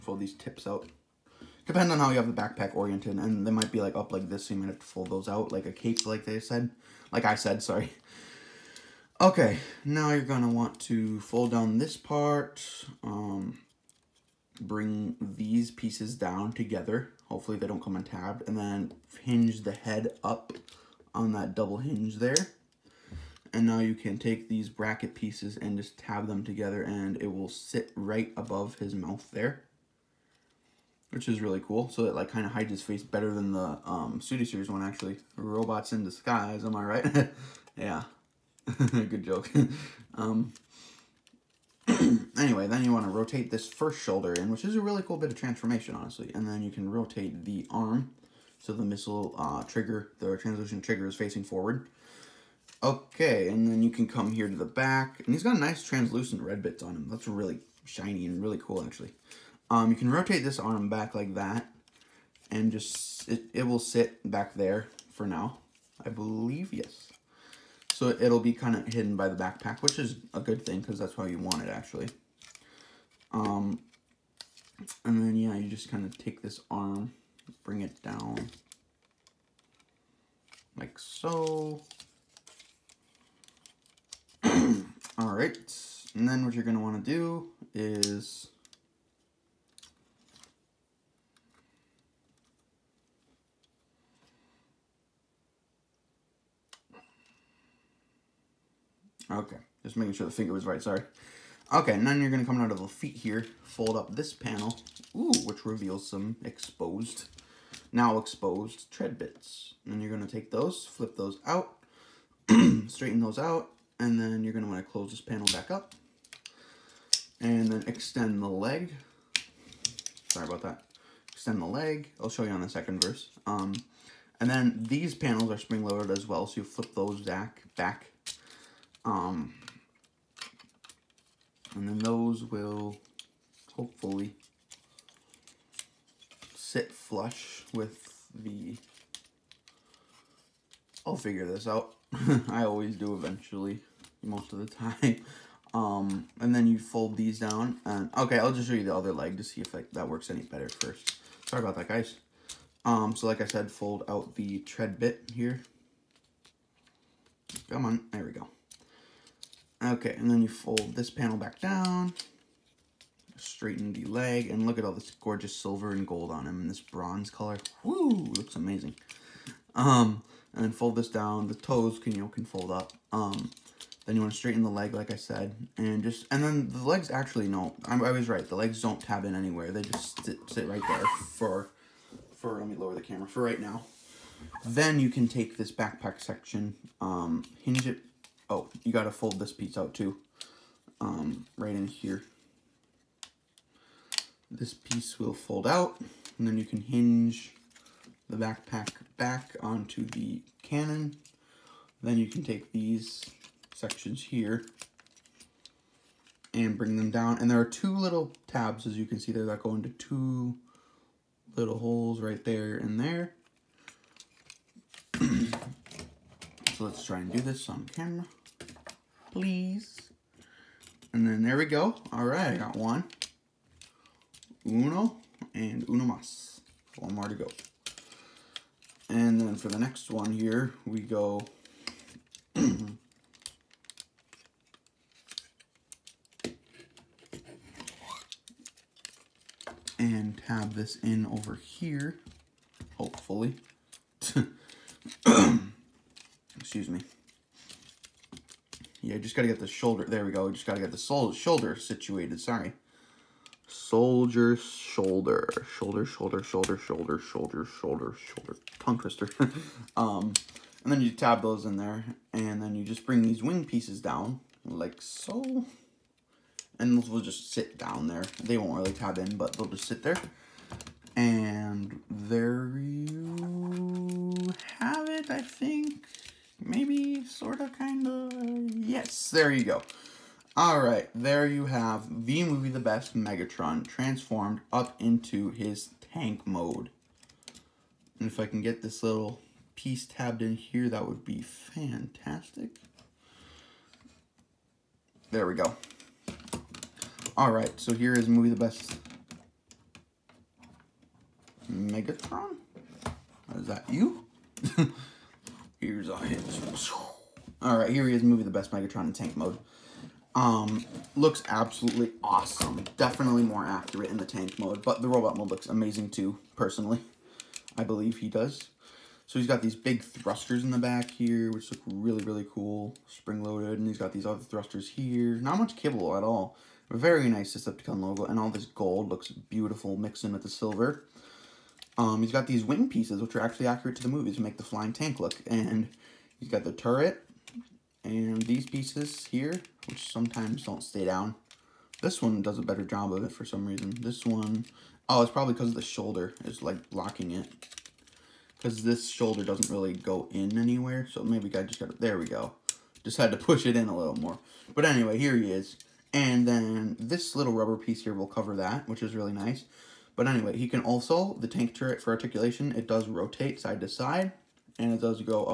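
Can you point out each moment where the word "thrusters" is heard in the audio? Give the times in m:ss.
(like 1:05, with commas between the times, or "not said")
5:20, 5:24.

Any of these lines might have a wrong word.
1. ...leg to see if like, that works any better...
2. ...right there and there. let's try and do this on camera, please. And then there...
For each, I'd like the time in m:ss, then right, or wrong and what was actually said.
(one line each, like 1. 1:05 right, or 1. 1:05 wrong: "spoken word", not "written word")
1. 2:29 right
2. 3:32 right.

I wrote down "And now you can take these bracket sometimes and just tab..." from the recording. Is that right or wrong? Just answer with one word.
wrong.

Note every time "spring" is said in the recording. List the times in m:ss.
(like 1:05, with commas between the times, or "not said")
2:05, 5:23.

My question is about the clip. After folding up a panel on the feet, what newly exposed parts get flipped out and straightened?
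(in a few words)
tread bits.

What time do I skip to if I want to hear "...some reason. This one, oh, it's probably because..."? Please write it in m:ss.
5:43.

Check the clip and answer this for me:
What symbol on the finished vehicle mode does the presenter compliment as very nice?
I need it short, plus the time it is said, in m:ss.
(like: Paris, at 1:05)
Decepticon logo, at 5:27.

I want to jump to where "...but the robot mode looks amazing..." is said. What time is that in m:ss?
5:14.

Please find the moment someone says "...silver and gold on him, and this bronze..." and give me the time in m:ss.
2:45.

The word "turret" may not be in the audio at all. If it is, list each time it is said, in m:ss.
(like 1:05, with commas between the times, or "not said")
5:36, 6:01.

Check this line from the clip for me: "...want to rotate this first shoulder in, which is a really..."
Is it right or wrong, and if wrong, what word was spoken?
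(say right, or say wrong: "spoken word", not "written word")
right.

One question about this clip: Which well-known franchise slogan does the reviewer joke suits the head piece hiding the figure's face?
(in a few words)
Robots in disguise.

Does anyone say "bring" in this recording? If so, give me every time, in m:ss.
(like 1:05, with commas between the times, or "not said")
0:14, 1:17, 3:26, 4:23.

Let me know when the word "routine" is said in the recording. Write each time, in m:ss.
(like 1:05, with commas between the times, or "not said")
not said.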